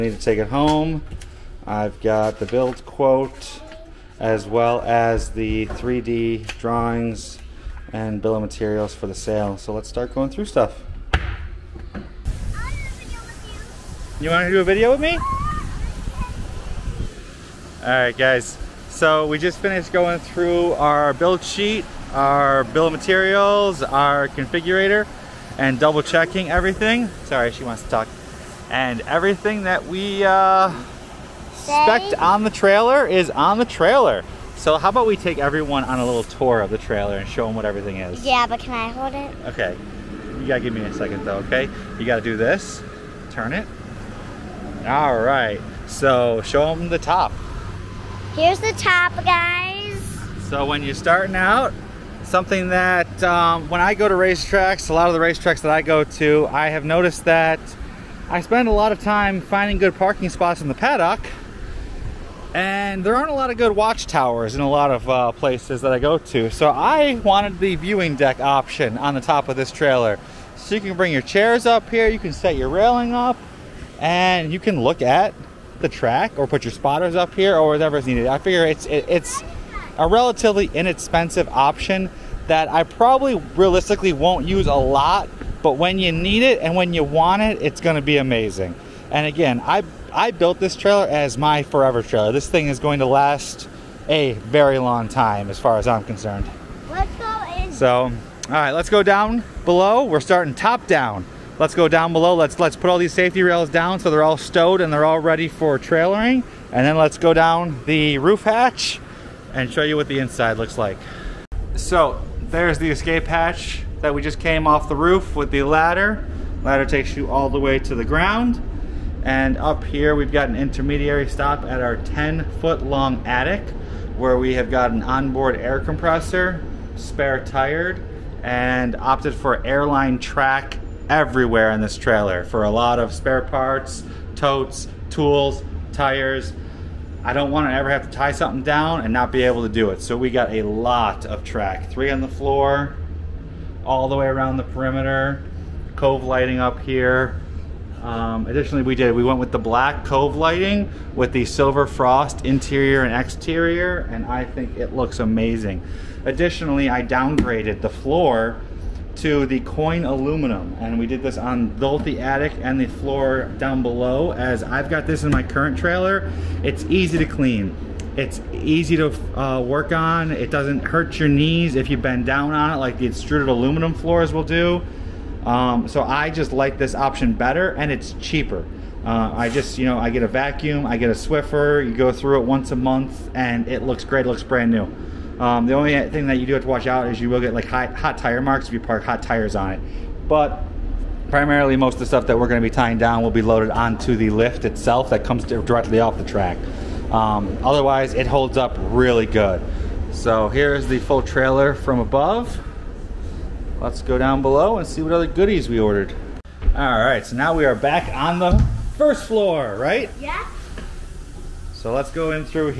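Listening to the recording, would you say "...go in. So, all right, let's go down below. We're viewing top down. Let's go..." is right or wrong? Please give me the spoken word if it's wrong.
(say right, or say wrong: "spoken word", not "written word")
wrong: "starting", not "viewing".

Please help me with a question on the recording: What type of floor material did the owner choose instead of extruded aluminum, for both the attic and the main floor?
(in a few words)
coin aluminum.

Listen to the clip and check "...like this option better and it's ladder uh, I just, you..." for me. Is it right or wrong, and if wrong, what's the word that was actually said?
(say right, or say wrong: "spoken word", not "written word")
wrong: "cheaper", not "ladder".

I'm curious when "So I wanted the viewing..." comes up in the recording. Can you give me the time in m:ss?
1:06.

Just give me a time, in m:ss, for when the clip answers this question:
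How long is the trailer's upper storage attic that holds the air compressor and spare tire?
2:01.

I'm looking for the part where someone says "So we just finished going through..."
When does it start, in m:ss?
0:18.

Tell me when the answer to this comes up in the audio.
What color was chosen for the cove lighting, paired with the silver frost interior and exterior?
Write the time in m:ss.
2:29.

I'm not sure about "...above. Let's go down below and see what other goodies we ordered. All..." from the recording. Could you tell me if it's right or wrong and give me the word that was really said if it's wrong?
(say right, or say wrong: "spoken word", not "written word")
right.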